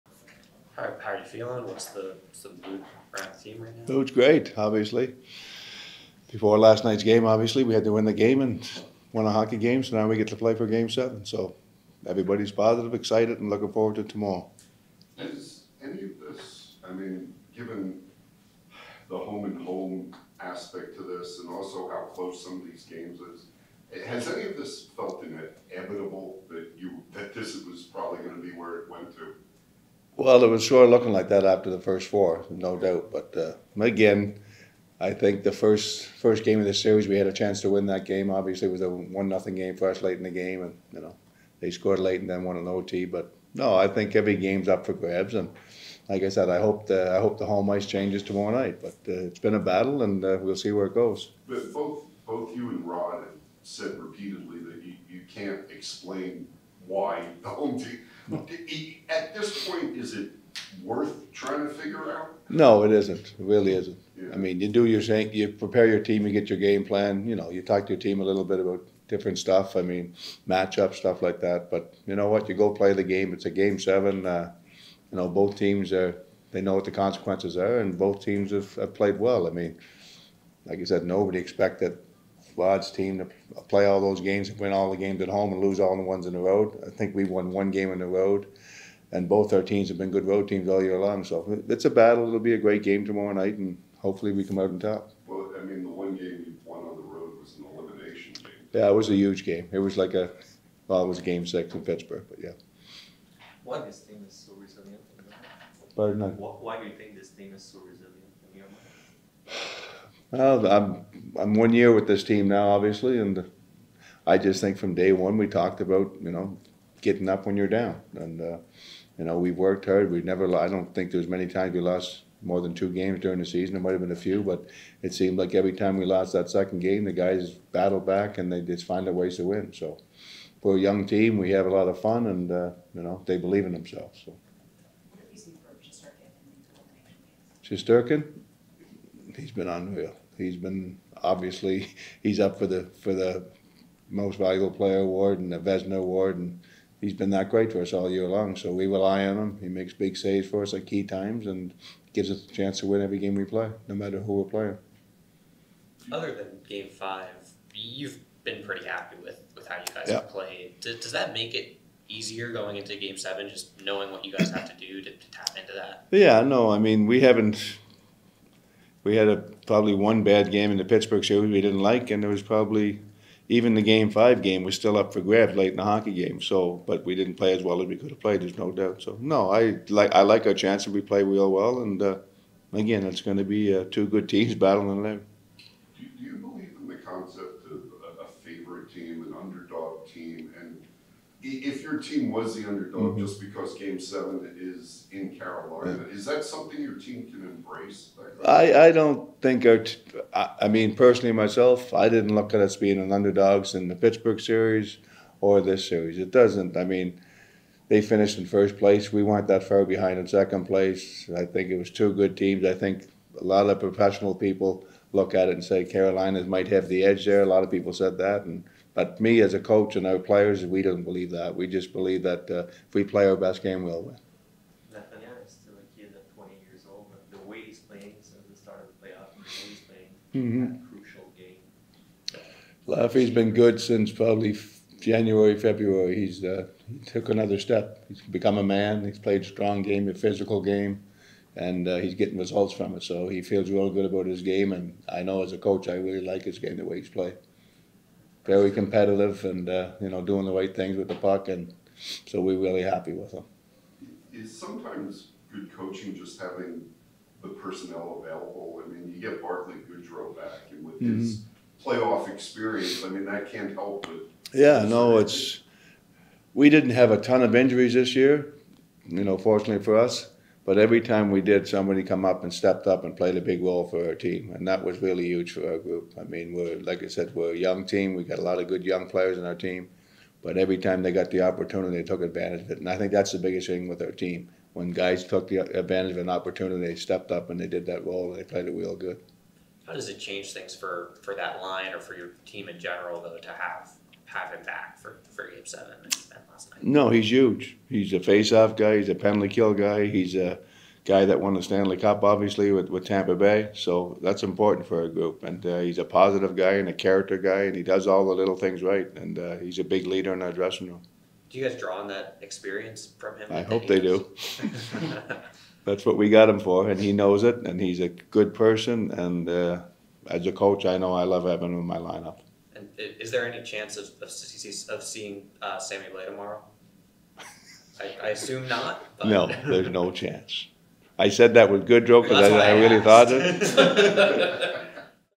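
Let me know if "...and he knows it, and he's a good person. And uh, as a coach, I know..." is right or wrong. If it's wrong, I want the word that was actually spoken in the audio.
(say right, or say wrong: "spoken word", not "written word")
right.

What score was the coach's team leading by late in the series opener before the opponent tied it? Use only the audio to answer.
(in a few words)
1-0.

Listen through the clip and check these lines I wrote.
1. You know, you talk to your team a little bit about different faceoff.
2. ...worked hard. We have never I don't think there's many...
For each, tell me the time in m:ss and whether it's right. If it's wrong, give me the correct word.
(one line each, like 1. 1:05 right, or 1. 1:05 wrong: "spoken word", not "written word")
1. 1:07 wrong: "stuff", not "faceoff"
2. 1:59 right.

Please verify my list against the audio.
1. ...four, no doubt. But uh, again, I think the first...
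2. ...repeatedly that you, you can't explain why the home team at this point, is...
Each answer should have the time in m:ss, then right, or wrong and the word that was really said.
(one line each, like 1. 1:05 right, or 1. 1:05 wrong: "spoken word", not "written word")
1. 0:32 right
2. 0:53 right.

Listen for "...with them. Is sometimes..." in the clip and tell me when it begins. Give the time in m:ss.
4:13.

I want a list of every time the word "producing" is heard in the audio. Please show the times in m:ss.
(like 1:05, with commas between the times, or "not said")
not said.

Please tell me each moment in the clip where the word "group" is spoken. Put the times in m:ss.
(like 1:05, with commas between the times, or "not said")
4:35, 5:05.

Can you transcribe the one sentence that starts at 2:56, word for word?
So, but we didn't play as well as we could have played.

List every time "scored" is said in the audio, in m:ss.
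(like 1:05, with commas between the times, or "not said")
0:41.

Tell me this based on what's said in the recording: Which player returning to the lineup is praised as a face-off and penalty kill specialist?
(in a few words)
Barclay Goodrow.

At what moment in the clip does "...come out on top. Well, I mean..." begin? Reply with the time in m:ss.
1:34.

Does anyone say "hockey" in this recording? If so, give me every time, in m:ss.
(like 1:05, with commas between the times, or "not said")
0:09, 2:55.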